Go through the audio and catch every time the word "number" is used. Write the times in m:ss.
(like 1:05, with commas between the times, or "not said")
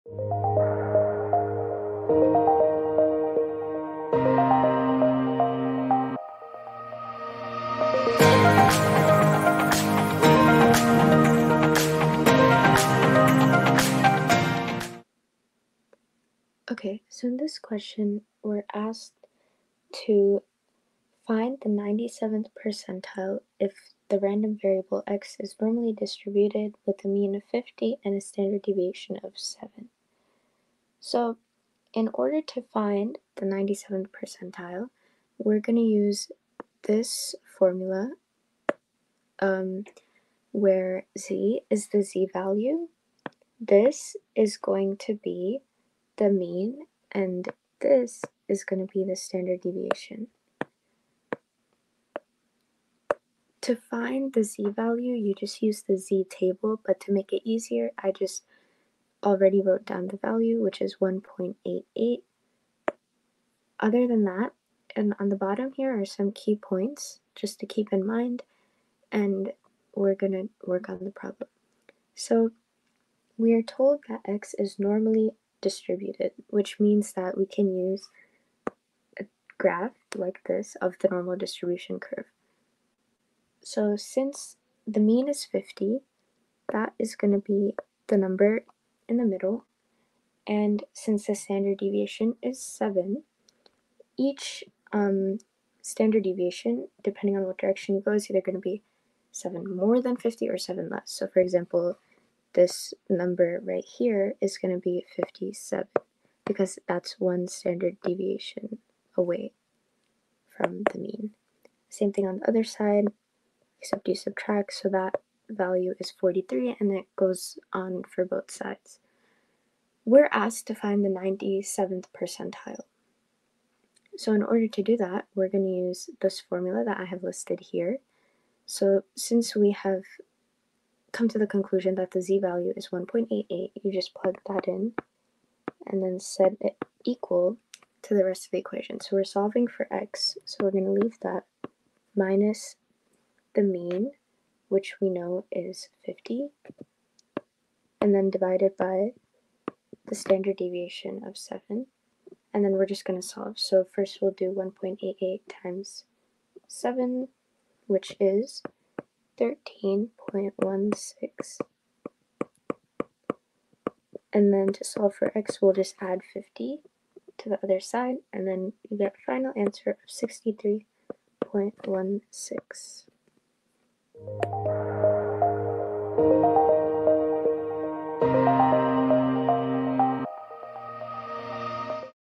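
1:28, 1:43.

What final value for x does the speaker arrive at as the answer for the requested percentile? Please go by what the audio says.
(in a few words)
63.16.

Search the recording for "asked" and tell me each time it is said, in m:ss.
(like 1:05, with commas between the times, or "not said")
0:18, 2:00.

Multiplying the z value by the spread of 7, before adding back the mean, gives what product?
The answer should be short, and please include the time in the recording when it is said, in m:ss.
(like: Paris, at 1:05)
13.16, at 2:39.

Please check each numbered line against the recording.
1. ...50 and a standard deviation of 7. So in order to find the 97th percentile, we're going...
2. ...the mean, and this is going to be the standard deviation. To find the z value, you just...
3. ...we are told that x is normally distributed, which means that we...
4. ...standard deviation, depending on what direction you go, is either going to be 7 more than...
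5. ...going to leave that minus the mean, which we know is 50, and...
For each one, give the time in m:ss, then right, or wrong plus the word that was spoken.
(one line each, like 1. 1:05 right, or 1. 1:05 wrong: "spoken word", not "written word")
1. 0:27 right
2. 0:46 right
3. 1:13 right
4. 1:35 right
5. 2:20 right.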